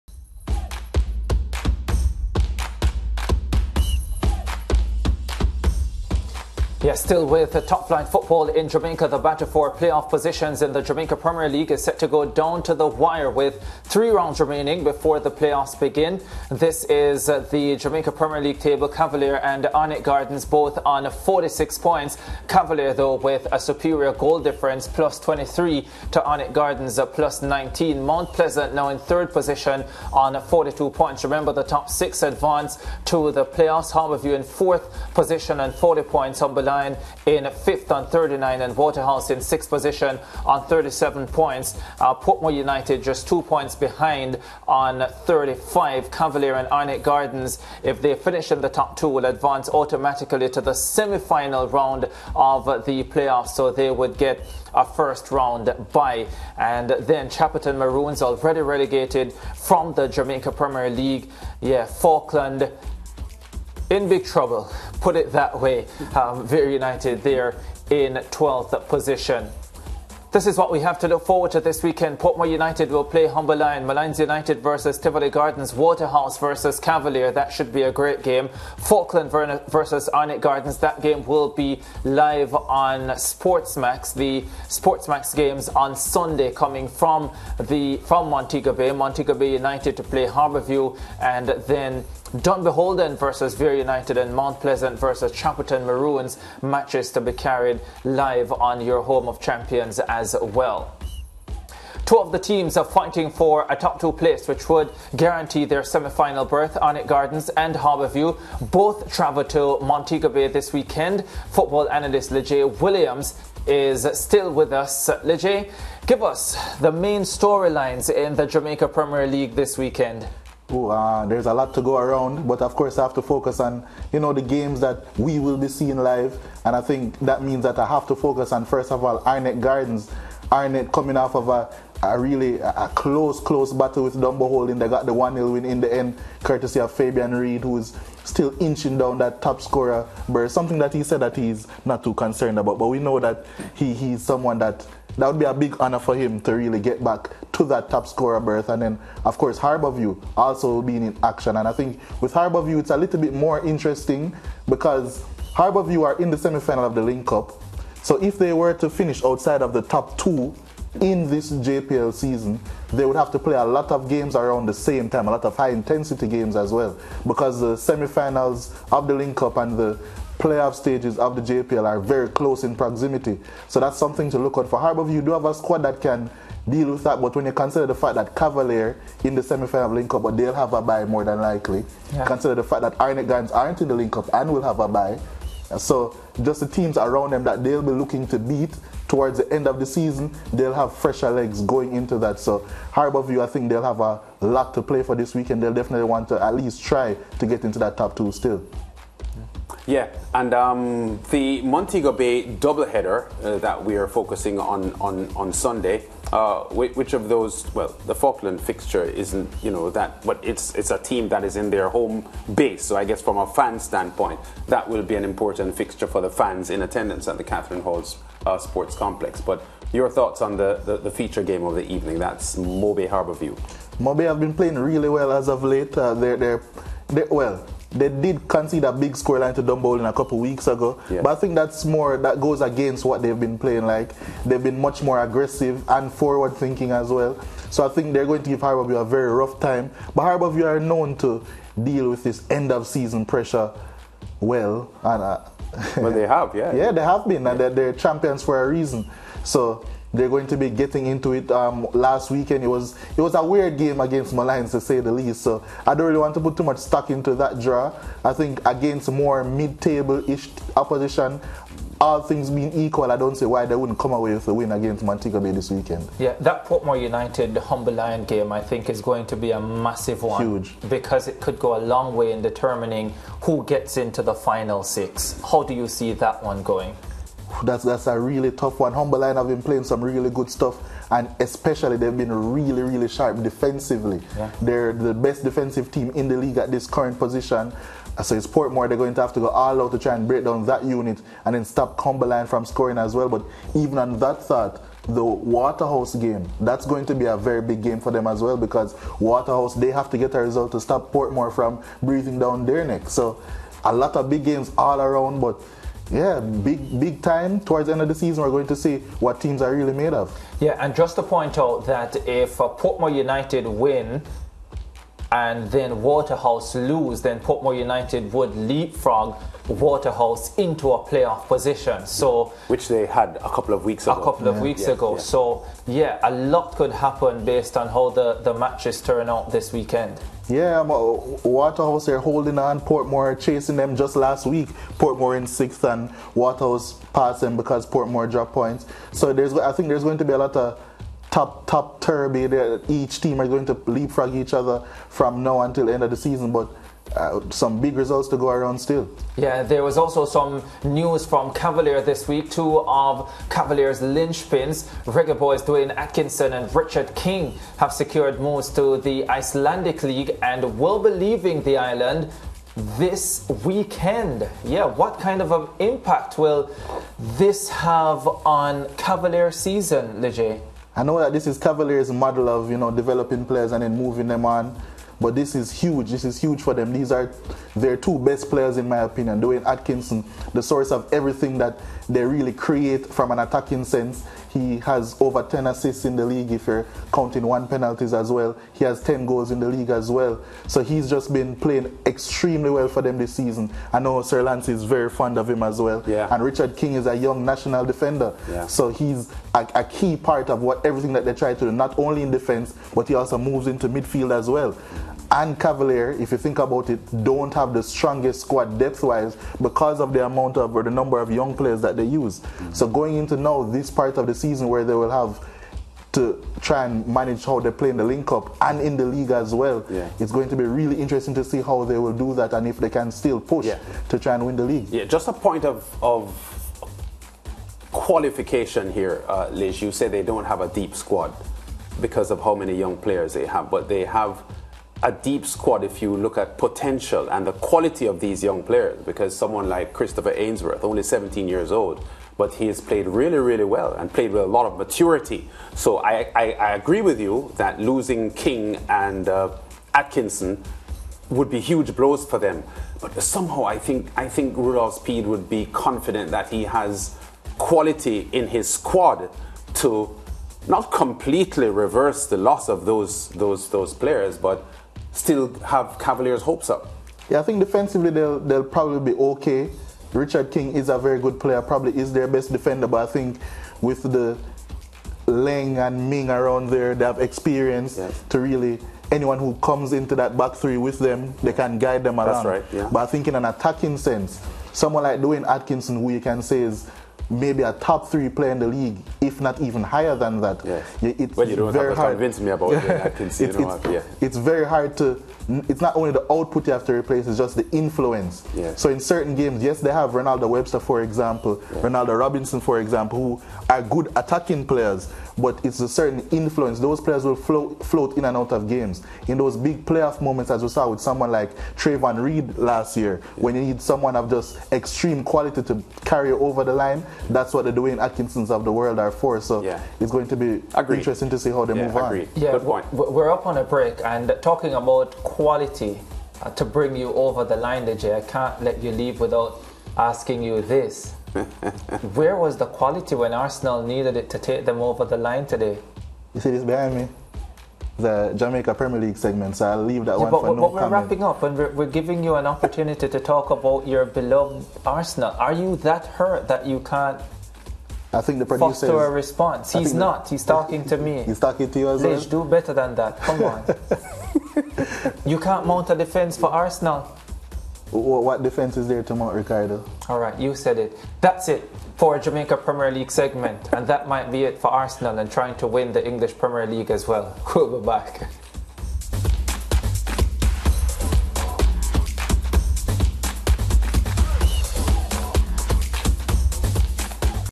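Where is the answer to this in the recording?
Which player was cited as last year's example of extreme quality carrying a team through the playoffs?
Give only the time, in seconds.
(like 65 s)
511 s.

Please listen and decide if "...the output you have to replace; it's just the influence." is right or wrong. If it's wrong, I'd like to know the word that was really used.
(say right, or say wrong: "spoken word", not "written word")
right.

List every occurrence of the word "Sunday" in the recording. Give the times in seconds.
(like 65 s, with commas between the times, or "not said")
85 s, 205 s.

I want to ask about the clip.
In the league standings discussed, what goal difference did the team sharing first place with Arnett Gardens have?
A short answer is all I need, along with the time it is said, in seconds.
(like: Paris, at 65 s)
+23, at 24 s.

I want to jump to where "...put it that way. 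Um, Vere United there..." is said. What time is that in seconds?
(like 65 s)
65 s.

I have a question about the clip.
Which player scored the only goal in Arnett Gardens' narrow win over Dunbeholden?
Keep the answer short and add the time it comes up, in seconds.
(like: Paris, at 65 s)
Fabian Reed, at 136 s.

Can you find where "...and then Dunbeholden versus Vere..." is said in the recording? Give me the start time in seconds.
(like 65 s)
91 s.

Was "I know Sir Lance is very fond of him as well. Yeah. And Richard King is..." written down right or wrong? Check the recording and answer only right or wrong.
right.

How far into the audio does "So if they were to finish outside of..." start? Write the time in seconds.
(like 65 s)
158 s.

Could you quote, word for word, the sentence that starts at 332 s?
Portmore chasing them just last week.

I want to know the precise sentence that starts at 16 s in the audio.
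This is uh, the Jamaica Premier League table.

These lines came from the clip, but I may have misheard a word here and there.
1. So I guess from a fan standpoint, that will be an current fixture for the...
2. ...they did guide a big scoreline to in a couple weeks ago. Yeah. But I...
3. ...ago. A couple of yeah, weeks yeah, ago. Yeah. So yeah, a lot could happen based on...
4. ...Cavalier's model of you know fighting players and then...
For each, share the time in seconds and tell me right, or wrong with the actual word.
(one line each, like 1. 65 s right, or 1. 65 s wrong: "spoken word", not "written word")
1. 212 s wrong: "important", not "current"
2. 227 s wrong: "concede", not "guide"
3. 324 s right
4. 371 s wrong: "developing", not "fighting".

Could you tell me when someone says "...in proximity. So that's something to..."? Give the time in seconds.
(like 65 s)
172 s.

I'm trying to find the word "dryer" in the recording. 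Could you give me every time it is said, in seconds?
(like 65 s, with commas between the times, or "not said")
not said.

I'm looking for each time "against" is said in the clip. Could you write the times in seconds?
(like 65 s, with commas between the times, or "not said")
232 s, 254 s, 258 s, 264 s.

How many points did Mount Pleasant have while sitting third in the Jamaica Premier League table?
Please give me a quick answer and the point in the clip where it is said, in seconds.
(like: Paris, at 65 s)
42, at 30 s.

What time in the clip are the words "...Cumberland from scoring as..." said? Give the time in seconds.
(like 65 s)
291 s.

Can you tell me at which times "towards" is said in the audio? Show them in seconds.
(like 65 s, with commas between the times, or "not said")
189 s, 307 s.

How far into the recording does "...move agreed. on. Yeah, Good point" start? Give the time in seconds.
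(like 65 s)
521 s.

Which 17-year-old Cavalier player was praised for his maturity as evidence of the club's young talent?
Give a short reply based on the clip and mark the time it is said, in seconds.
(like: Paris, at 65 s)
Christopher Ainsworth, at 439 s.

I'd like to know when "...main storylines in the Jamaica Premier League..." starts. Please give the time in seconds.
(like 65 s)
116 s.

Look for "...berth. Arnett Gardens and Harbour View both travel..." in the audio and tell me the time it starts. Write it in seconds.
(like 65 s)
106 s.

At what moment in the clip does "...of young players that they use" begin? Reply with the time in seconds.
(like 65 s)
411 s.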